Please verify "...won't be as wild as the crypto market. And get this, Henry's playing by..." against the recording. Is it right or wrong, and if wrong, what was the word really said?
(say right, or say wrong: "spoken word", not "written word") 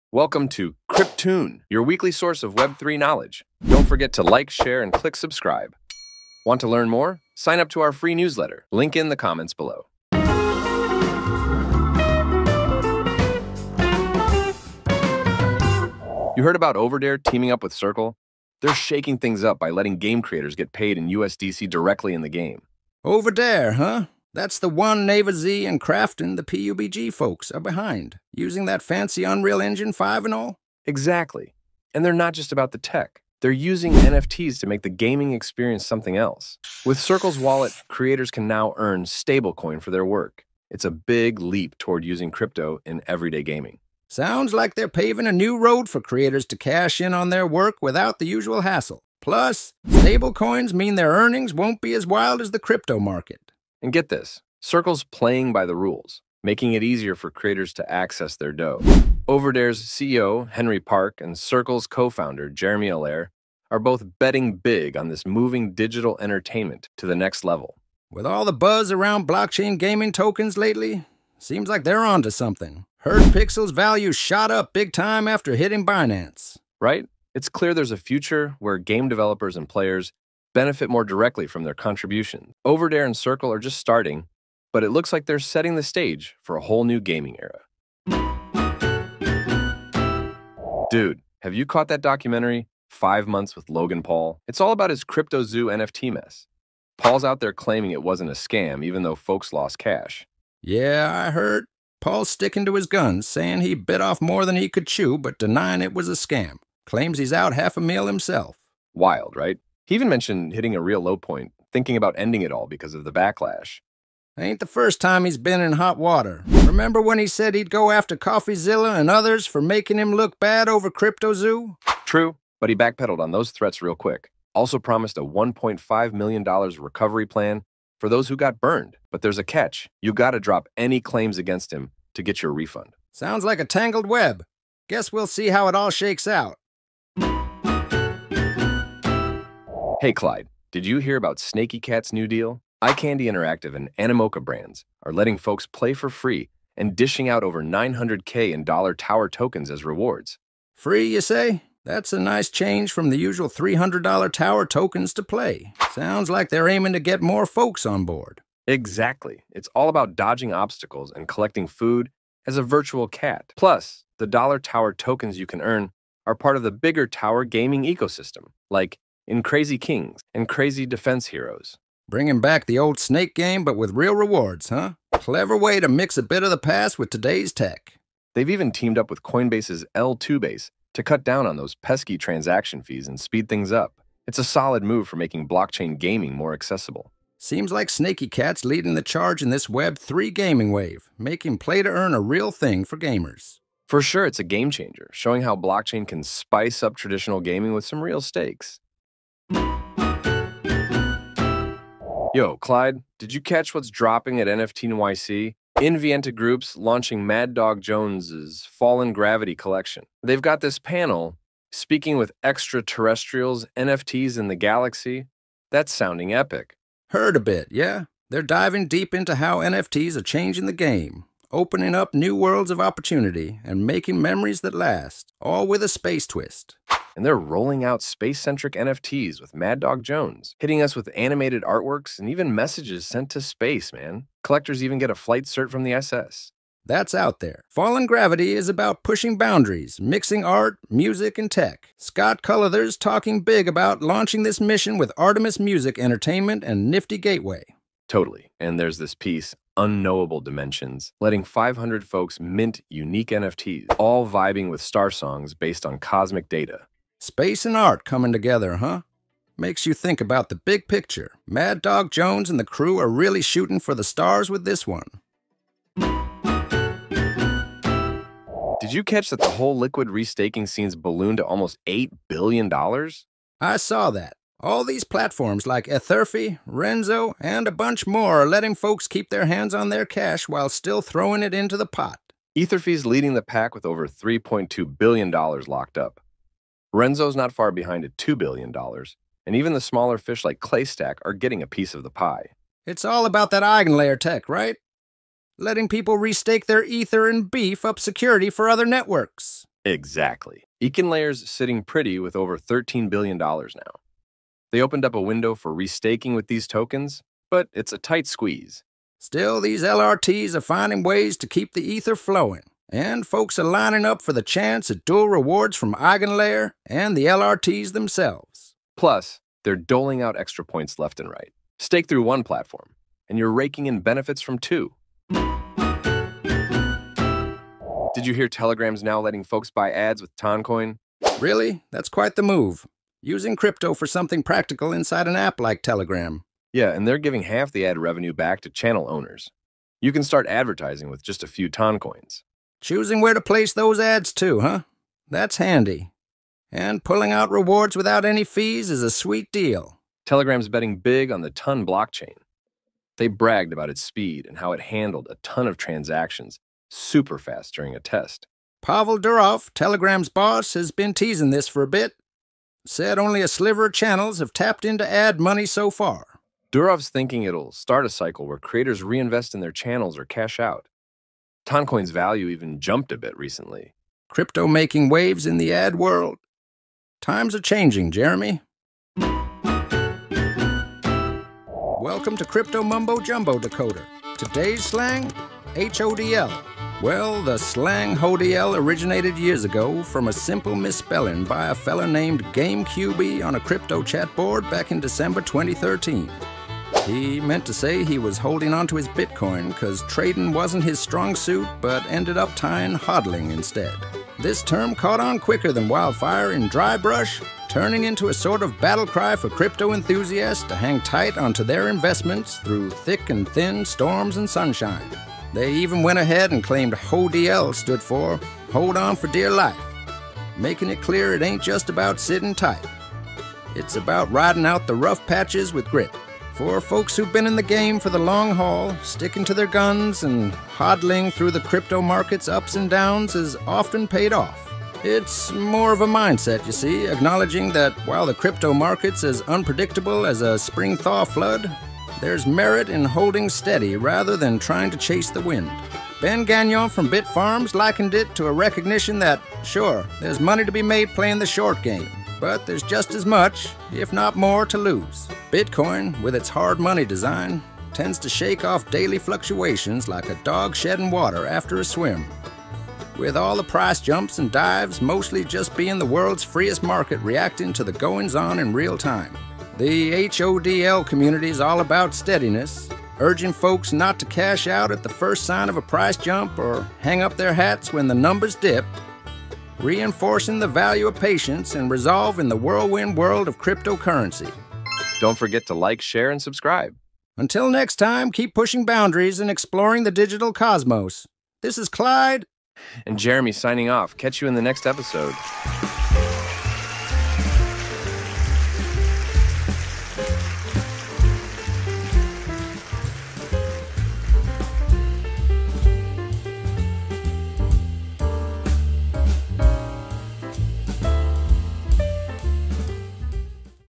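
wrong: "Circle", not "Henry".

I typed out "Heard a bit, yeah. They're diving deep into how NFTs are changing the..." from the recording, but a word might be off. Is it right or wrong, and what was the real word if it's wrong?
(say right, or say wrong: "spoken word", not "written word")
right.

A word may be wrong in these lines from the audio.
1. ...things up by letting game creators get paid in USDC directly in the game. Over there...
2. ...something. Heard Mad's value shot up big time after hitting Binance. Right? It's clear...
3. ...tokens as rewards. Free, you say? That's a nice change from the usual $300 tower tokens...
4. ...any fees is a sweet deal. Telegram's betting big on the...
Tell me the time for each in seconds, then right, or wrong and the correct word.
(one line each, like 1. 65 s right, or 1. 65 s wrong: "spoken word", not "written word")
1. 19 s right
2. 72 s wrong: "Pixel", not "Mad"
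3. 149 s right
4. 348 s right.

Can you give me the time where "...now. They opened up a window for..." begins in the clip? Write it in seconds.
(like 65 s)
303 s.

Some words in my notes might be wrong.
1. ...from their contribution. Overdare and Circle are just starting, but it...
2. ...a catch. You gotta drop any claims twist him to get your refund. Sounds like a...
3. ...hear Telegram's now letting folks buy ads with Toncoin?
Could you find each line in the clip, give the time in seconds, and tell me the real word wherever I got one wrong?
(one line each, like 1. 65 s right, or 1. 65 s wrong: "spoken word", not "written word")
1. 81 s right
2. 129 s wrong: "against", not "twist"
3. 328 s right.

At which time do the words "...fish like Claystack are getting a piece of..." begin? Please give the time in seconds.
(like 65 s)
290 s.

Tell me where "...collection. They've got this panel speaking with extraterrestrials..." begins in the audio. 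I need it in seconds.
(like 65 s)
209 s.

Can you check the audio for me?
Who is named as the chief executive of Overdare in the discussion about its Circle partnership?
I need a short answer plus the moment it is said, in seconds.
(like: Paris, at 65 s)
Henry Park, at 60 s.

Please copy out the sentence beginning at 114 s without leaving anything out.
Ain't the first time he's been in hot water.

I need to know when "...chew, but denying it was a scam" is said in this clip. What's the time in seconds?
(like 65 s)
104 s.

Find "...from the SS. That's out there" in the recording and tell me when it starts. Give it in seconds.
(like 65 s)
235 s.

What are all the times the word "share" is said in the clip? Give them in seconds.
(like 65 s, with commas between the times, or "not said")
4 s, 486 s.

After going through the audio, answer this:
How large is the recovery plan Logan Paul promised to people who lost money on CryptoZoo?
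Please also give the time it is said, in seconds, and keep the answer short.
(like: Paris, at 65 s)
$1.5 million, at 125 s.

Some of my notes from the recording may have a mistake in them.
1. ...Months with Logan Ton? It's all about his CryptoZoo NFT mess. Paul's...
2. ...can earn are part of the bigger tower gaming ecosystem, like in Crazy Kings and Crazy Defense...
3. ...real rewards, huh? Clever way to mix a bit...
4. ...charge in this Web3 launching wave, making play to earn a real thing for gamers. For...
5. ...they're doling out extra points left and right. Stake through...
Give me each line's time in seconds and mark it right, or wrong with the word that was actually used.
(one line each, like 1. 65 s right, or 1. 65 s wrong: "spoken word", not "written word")
1. 93 s wrong: "Paul", not "Ton"
2. 165 s right
3. 173 s right
4. 189 s wrong: "gaming", not "launching"
5. 319 s right.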